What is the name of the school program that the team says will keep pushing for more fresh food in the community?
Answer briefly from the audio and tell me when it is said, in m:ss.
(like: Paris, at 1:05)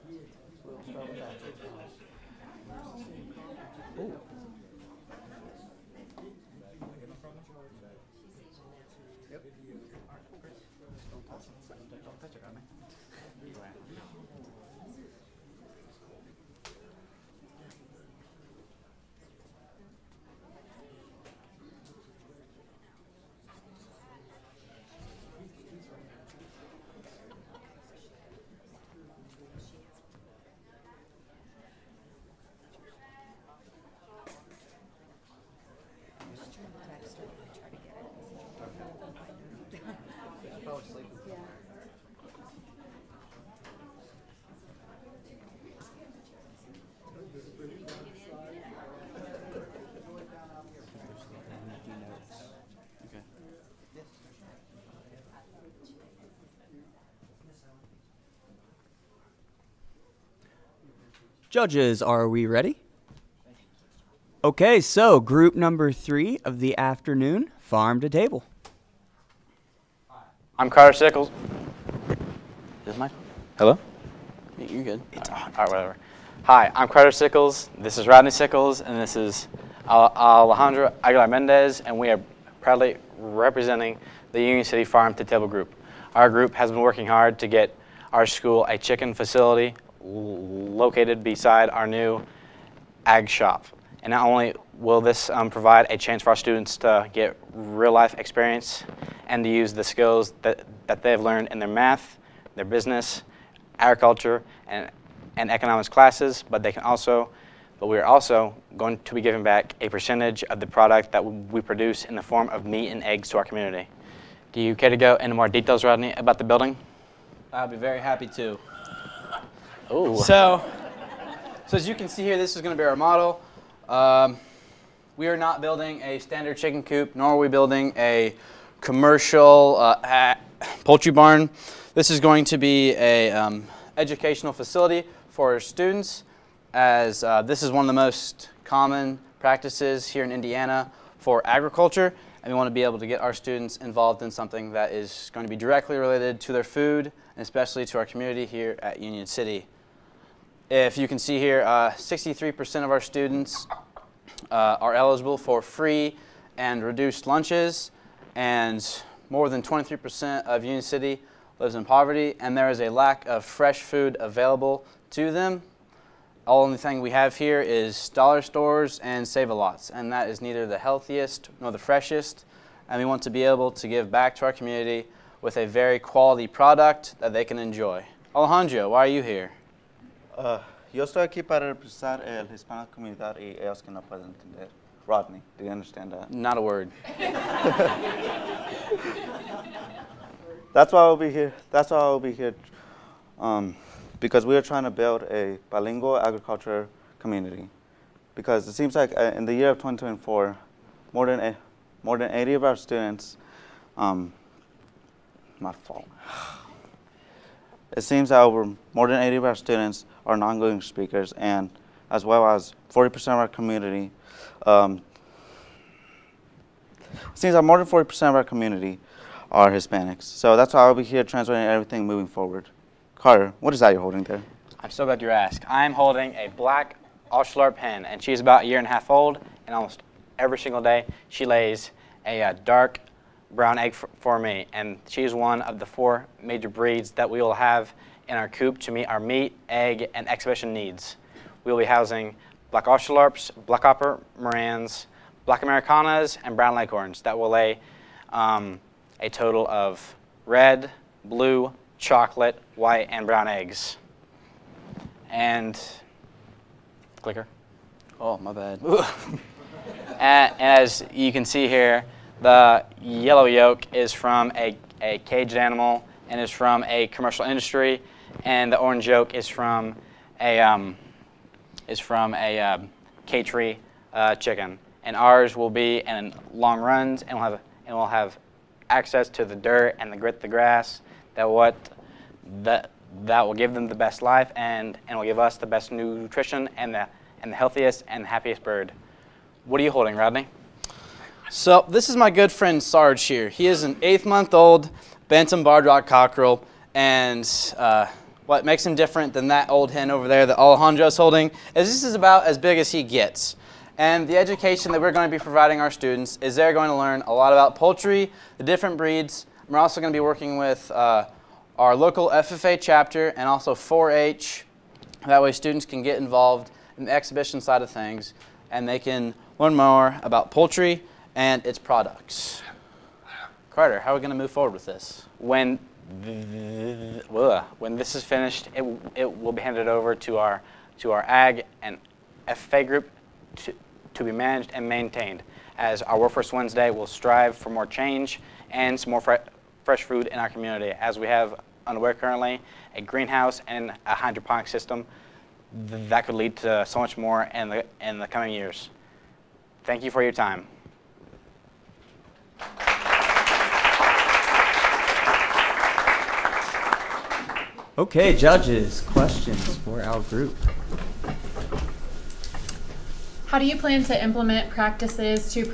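Workforce Wednesday, at 5:36.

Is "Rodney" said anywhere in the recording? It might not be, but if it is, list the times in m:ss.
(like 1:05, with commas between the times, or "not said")
1:18, 1:55, 3:05, 4:50.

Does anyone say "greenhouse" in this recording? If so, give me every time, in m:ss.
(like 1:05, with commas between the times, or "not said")
5:43.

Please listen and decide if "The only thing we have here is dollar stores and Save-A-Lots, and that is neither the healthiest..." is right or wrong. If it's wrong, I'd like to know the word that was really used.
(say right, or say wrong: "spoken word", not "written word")
right.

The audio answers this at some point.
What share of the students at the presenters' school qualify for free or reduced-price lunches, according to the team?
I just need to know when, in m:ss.
2:31.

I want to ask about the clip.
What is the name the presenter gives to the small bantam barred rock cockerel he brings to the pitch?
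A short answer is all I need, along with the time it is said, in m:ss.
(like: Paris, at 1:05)
Sarge, at 4:52.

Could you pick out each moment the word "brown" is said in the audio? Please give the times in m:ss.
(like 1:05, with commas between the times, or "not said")
3:53, 4:06, 4:13.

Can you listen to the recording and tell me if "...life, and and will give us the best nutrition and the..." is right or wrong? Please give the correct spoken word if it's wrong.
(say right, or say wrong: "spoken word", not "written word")
right.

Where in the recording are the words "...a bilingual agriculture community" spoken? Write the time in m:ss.
3:15.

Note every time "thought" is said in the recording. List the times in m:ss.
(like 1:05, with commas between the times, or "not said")
not said.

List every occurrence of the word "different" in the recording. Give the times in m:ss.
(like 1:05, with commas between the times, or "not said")
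4:58, 5:08.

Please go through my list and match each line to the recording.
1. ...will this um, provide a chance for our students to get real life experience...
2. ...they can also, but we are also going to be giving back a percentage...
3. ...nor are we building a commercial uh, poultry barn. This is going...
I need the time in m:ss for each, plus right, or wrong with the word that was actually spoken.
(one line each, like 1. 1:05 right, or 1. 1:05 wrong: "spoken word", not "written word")
1. 1:34 right
2. 1:46 right
3. 2:07 right.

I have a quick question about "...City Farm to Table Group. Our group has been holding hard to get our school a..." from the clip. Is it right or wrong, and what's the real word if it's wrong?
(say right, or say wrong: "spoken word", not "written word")
wrong: "working", not "holding".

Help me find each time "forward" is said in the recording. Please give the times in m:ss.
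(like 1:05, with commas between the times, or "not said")
3:42, 5:24.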